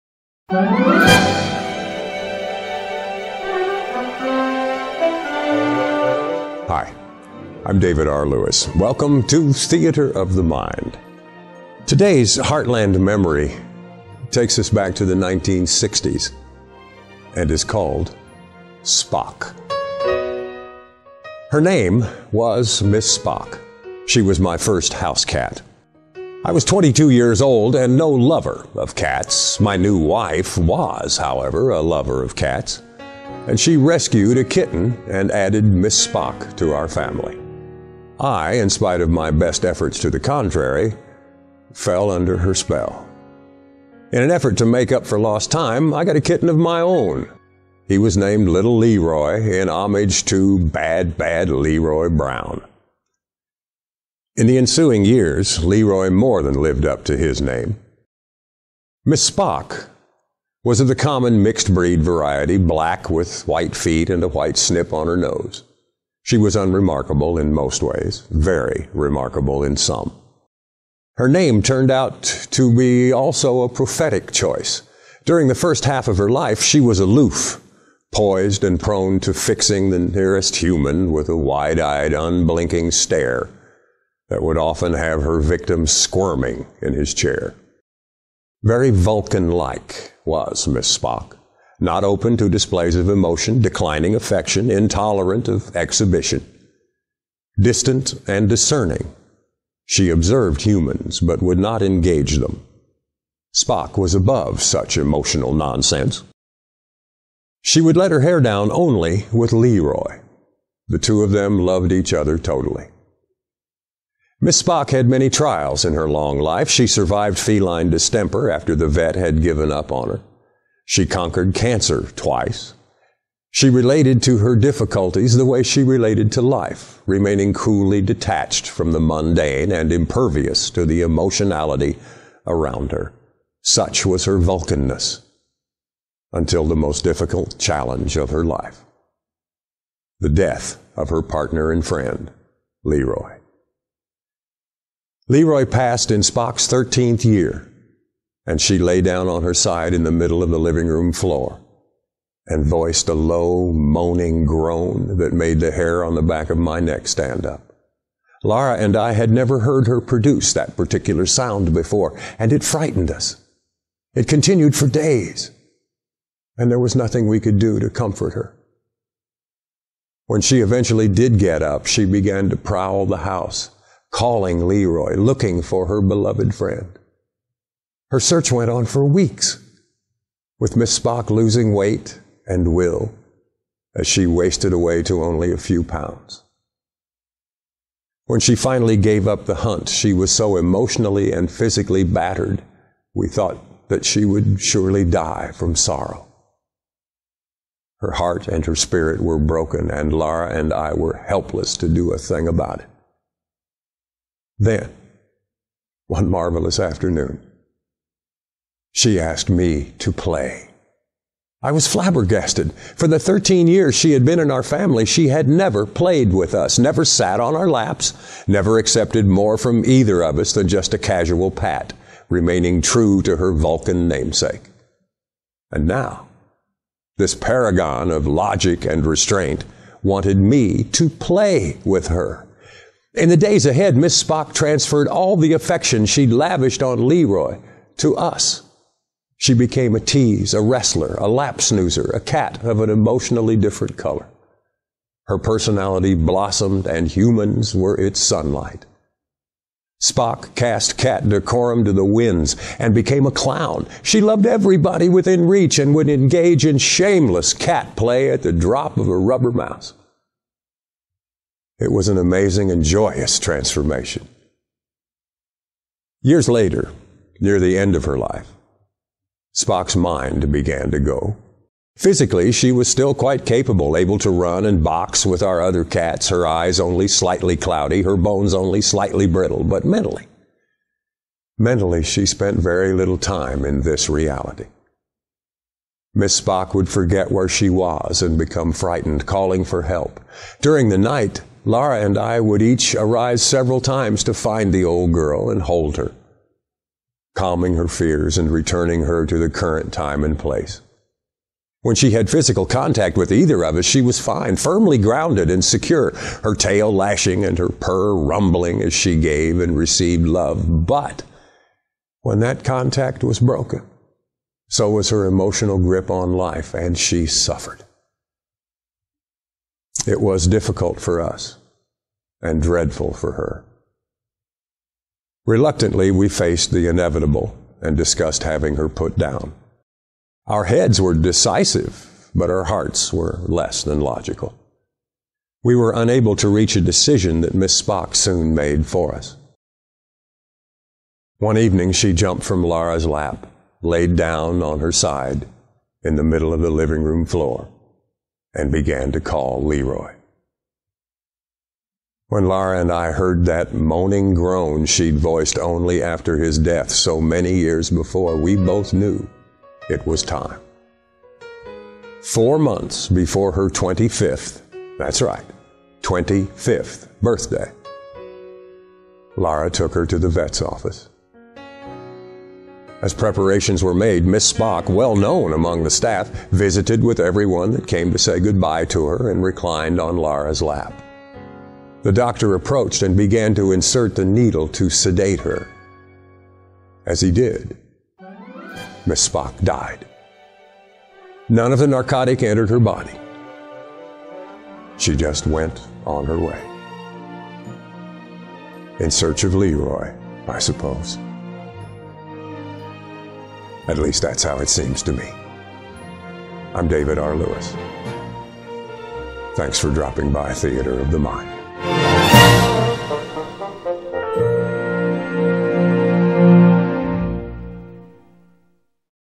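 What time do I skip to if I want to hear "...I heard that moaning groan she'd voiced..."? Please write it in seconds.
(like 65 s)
352 s.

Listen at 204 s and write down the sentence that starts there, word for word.
Then, one marvelous afternoon, she asked me to play.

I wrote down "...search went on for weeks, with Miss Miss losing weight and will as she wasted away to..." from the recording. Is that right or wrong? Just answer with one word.
wrong.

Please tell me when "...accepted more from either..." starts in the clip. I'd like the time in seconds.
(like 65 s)
218 s.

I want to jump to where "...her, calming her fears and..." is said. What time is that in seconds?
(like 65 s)
295 s.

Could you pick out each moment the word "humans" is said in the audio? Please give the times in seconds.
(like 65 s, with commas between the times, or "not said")
80 s, 100 s, 247 s.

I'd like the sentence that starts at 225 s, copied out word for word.
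And now, this paragon of logic and restraint wanted me to play with her.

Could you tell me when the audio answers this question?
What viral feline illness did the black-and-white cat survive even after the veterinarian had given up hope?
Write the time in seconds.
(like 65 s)
117 s.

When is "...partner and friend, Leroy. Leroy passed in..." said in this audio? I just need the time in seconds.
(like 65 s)
141 s.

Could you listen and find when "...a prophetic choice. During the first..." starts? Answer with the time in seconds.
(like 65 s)
73 s.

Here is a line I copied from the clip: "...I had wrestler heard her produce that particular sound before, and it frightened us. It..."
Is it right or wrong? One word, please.
wrong.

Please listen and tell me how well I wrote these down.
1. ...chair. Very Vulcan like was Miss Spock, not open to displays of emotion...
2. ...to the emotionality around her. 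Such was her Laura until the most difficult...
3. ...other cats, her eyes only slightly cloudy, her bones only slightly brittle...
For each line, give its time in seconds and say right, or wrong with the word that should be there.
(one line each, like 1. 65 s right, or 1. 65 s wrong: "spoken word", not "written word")
1. 87 s right
2. 130 s wrong: "Vulcanness", not "Laura"
3. 275 s right.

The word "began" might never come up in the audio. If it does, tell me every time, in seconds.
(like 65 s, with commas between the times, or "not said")
172 s, 270 s, 348 s, 383 s.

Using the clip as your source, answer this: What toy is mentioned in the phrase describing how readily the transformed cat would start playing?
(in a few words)
rubber mouse.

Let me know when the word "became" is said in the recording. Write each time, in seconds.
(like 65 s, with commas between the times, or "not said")
239 s, 252 s.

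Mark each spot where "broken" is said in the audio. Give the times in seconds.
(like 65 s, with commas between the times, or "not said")
199 s, 313 s.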